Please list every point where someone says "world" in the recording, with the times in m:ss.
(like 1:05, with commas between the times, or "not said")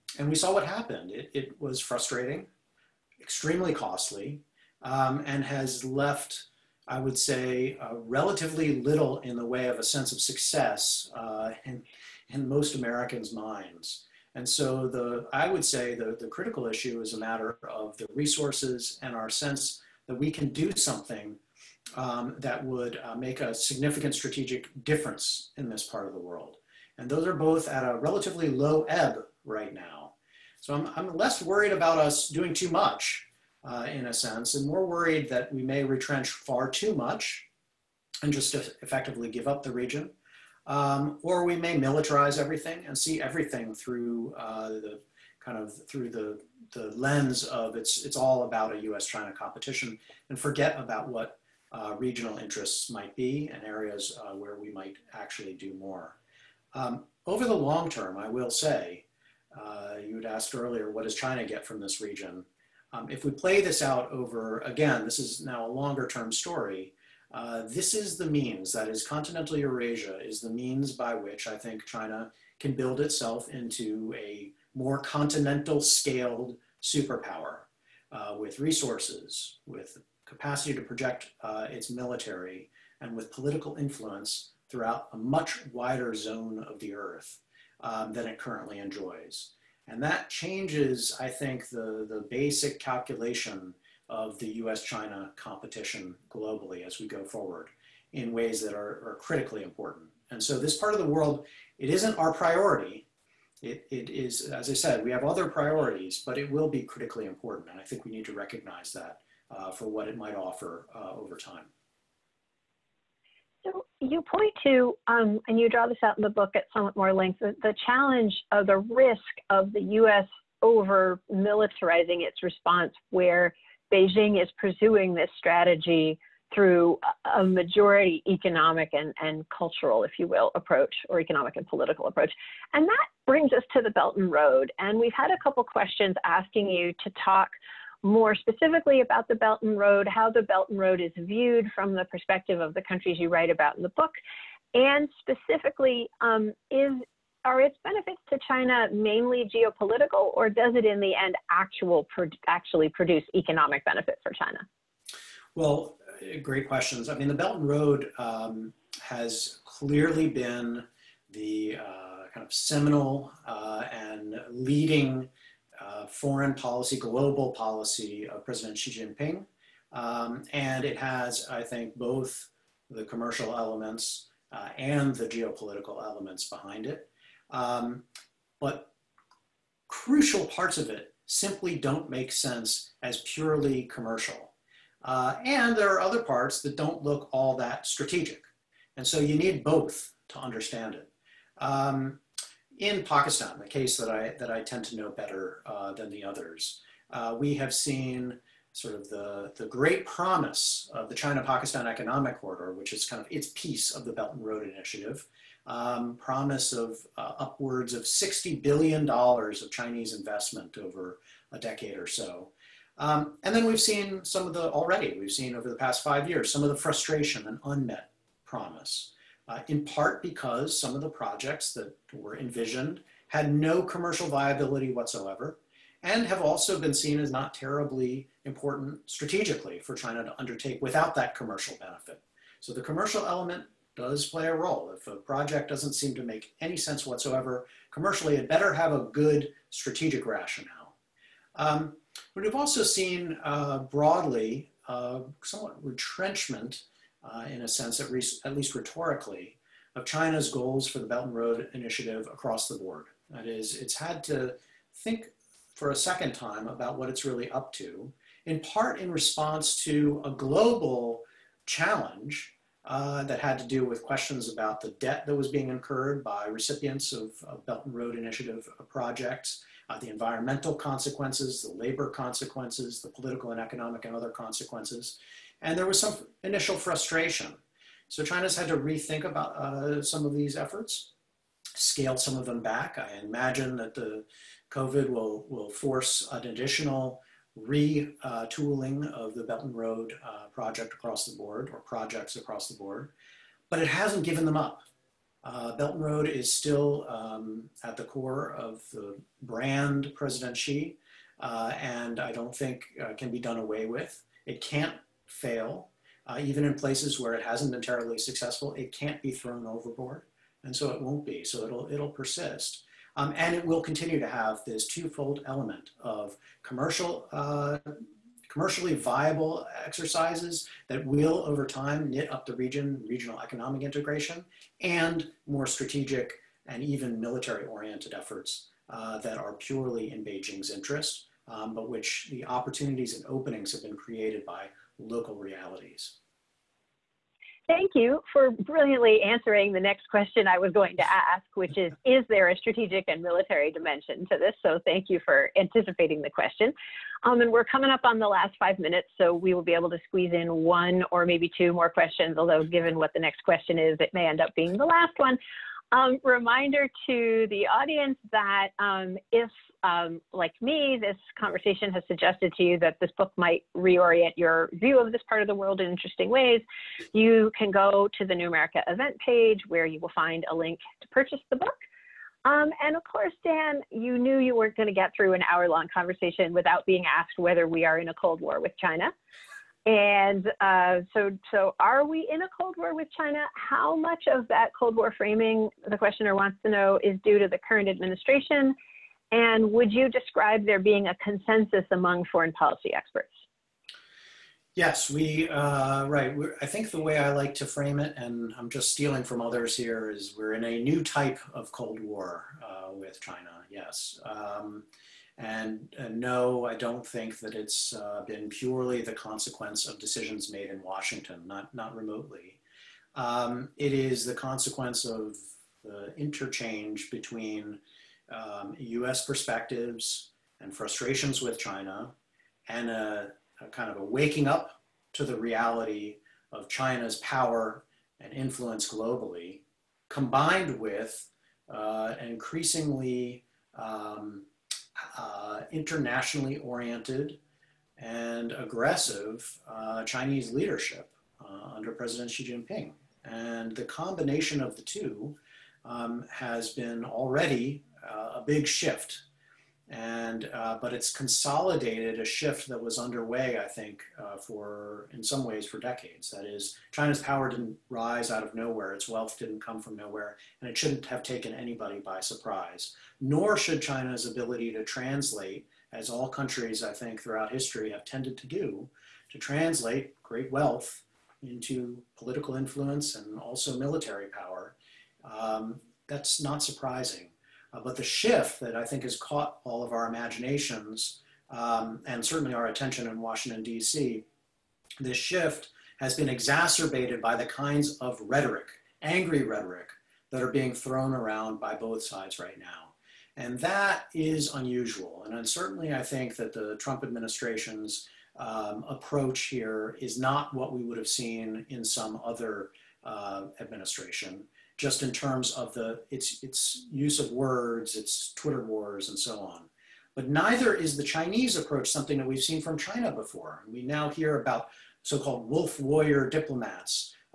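0:26, 1:41, 6:05.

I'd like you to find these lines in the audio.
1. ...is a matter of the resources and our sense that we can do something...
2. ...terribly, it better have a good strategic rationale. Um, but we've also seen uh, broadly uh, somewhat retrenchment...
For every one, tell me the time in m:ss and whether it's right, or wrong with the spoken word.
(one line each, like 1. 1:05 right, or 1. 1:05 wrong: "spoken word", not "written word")
1. 0:17 right
2. 3:57 wrong: "commercially", not "terribly".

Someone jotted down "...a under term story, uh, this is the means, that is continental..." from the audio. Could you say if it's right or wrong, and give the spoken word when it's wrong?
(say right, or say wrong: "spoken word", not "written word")
wrong: "longer", not "under".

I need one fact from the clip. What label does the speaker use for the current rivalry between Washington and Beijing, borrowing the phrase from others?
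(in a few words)
new type of Cold War.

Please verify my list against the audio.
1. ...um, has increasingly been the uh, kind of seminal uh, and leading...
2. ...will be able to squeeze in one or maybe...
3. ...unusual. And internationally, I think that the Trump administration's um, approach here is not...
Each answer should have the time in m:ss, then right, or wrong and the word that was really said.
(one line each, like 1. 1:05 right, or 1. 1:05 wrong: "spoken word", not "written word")
1. 2:38 wrong: "clearly", not "increasingly"
2. 5:49 right
3. 8:14 wrong: "certainly", not "internationally".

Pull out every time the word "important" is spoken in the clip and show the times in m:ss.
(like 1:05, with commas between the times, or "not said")
1:39, 1:47, 3:48.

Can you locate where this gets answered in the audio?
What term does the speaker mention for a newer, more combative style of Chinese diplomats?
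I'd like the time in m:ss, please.
8:35.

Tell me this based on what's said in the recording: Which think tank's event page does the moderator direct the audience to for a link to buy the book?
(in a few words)
New America.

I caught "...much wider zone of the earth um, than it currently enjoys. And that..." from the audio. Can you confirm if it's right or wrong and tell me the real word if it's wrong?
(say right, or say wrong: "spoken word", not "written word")
right.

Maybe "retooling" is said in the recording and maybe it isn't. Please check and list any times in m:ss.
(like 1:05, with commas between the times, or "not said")
4:47.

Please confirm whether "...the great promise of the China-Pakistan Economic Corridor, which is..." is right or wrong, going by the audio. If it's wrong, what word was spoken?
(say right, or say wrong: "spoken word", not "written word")
right.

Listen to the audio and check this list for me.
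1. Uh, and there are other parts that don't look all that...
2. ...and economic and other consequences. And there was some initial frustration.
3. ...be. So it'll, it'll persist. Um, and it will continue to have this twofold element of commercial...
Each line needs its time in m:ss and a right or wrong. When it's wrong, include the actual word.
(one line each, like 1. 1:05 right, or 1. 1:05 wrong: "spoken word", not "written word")
1. 3:05 right
2. 4:33 right
3. 5:11 right.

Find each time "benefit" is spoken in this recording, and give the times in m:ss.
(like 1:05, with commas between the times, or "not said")
2:27, 2:33, 3:51.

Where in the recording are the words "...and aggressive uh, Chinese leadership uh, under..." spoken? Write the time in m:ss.
7:17.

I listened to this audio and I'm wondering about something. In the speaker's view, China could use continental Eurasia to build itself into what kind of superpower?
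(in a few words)
continental scaled superpower.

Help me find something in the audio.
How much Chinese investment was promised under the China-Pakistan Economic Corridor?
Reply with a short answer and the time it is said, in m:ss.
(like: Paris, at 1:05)
$60 billion, at 3:28.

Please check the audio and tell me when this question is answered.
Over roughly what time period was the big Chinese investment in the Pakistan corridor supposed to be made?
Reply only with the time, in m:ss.
3:31.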